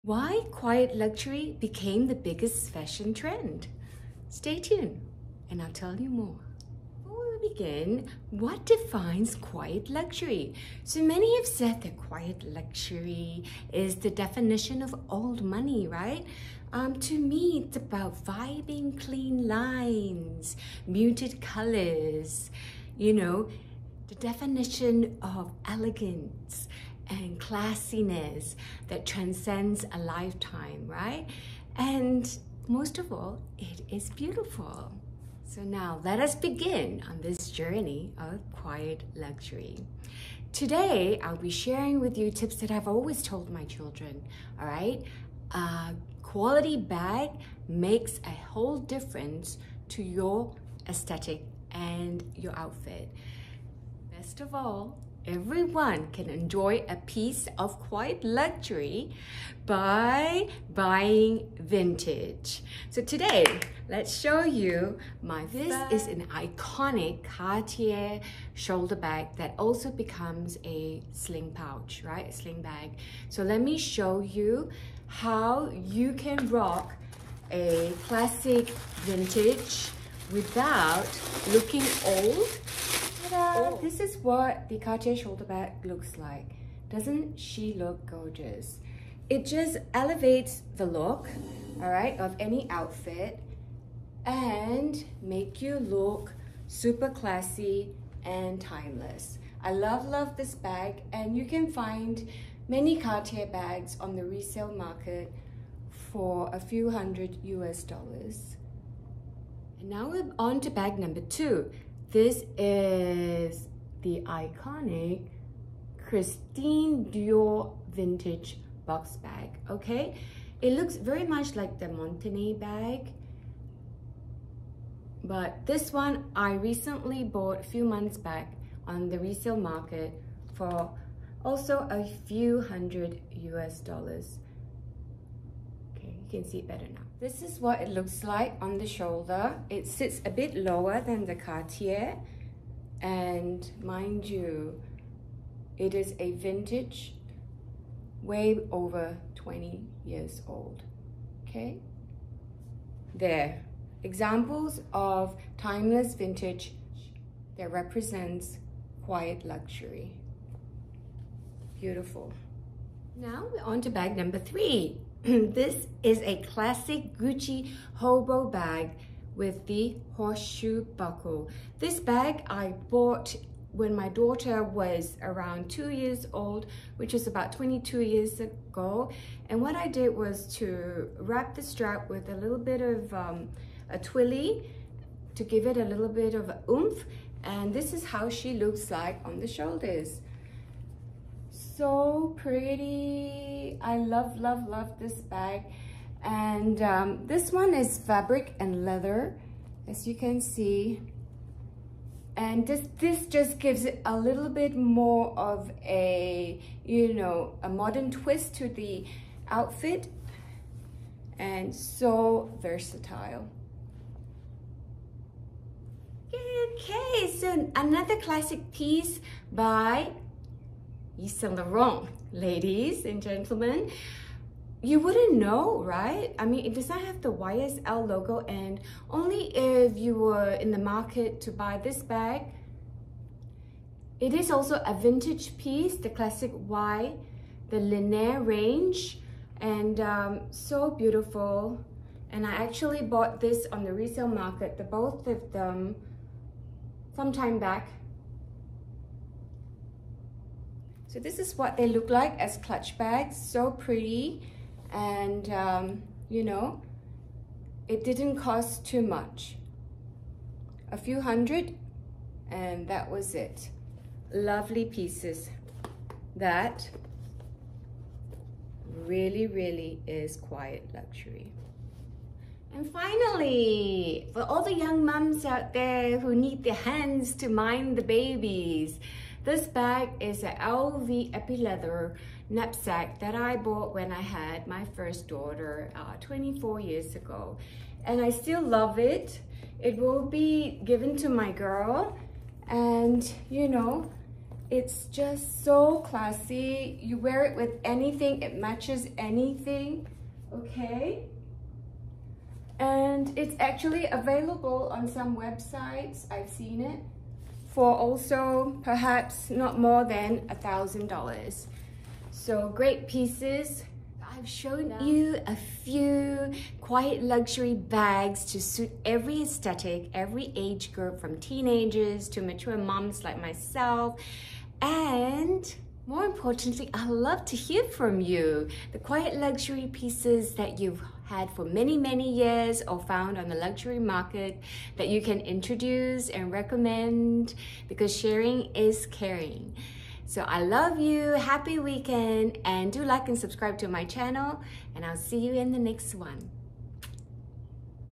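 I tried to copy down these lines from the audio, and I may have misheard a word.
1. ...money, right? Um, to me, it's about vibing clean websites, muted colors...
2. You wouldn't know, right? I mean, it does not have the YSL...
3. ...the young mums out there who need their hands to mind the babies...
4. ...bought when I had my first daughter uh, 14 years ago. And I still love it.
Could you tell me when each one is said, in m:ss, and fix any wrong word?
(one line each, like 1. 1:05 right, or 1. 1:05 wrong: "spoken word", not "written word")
1. 0:15 wrong: "lines", not "websites"
2. 3:44 right
3. 4:34 right
4. 4:43 wrong: "24", not "14".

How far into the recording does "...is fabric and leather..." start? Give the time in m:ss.
3:17.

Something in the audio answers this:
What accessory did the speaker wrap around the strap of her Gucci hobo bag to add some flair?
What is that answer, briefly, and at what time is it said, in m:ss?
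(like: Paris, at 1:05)
A twilly, at 3:03.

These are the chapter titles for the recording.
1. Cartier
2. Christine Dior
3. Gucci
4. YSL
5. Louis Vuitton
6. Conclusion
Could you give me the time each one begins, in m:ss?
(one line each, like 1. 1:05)
1. 1:06
2. 1:51
3. 2:45
4. 3:37
5. 4:34
6. 5:15.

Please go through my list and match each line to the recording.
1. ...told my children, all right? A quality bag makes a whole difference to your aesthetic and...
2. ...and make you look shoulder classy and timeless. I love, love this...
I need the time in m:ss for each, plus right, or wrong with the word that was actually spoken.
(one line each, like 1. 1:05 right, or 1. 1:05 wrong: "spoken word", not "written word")
1. 0:43 right
2. 1:34 wrong: "super", not "shoulder".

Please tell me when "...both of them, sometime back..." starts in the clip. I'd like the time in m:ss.
4:04.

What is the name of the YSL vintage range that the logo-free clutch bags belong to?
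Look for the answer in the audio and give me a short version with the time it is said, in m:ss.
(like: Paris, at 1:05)
Ligne, at 3:57.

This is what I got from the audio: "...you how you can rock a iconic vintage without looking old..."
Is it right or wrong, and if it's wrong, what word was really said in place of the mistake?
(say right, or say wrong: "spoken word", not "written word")
wrong: "classic", not "iconic".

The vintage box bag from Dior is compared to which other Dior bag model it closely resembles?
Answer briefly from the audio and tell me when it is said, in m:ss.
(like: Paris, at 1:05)
Montaigne, at 2:01.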